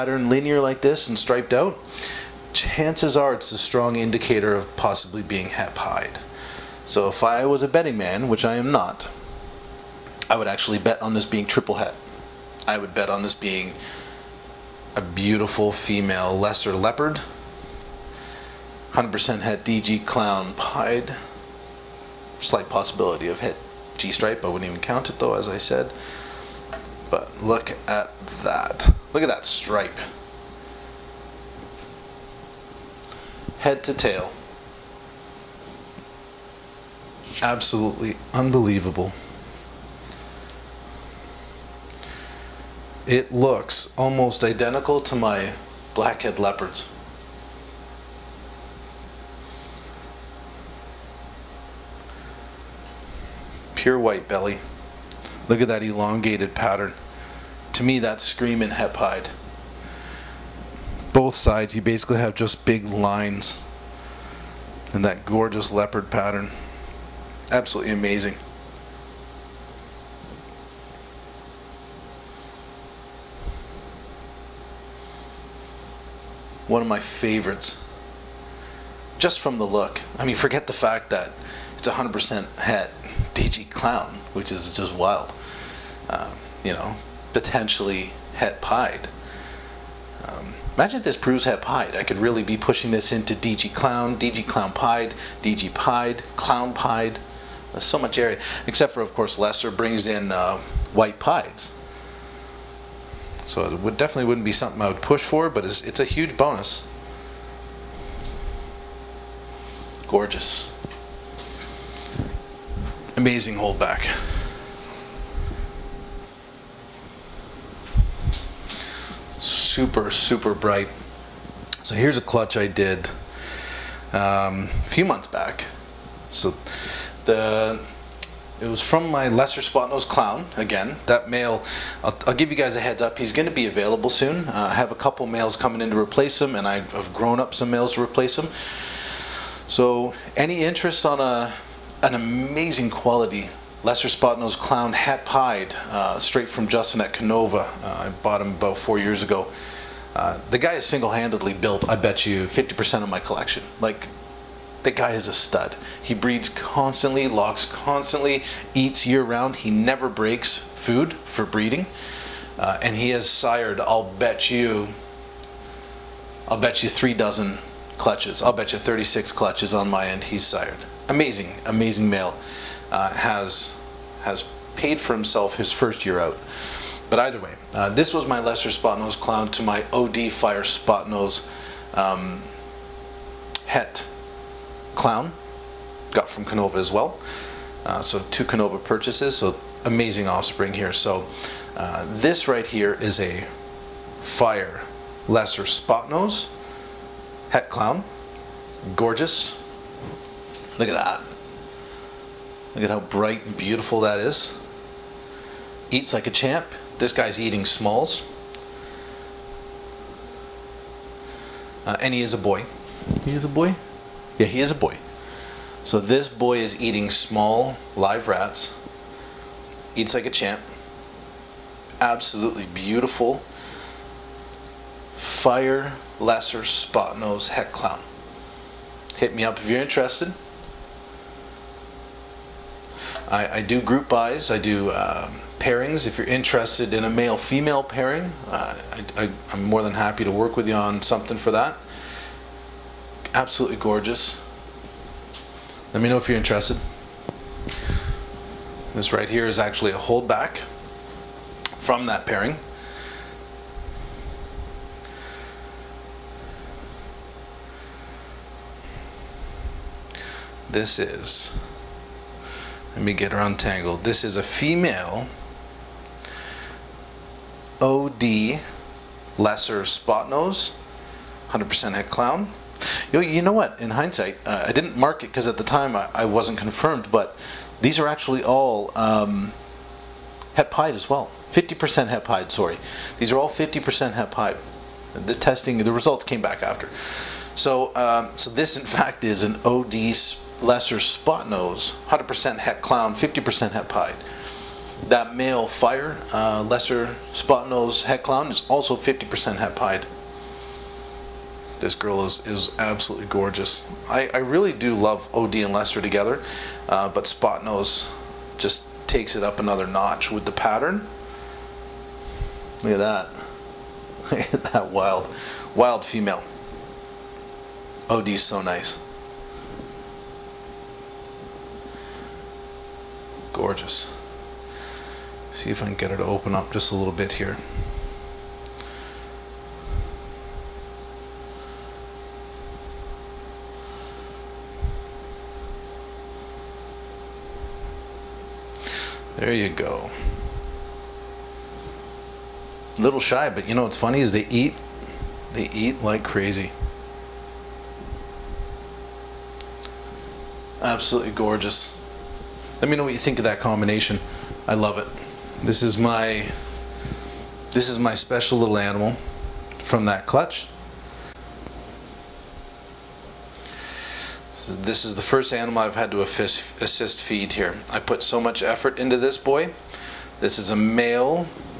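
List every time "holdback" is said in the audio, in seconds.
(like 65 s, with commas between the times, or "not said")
113 s, 249 s.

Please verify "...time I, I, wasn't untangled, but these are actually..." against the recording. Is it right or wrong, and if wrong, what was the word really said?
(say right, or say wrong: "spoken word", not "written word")
wrong: "confirmed", not "untangled".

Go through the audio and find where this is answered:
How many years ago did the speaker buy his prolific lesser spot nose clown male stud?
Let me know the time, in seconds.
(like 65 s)
148 s.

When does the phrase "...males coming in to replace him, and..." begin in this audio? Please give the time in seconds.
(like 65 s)
135 s.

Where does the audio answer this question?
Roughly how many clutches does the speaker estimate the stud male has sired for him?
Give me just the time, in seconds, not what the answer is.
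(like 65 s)
168 s.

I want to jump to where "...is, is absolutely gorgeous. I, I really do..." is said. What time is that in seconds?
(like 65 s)
302 s.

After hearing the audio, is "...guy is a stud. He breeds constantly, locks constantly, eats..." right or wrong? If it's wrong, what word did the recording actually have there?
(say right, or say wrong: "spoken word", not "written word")
right.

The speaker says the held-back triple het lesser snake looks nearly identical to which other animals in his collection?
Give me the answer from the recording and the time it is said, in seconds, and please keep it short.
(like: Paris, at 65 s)
blackhead leopards, at 45 s.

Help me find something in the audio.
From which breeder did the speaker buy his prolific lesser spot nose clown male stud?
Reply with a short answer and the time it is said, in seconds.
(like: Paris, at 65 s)
Justin at Kinova, at 146 s.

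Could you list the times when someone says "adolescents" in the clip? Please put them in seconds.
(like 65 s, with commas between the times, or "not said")
not said.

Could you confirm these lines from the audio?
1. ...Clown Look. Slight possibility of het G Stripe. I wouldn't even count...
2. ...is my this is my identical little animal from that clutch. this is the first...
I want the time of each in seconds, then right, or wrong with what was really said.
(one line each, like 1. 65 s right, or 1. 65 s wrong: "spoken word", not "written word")
1. 20 s wrong: "Pied", not "Look"
2. 355 s wrong: "special", not "identical".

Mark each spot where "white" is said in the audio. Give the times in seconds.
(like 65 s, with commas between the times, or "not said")
53 s, 100 s.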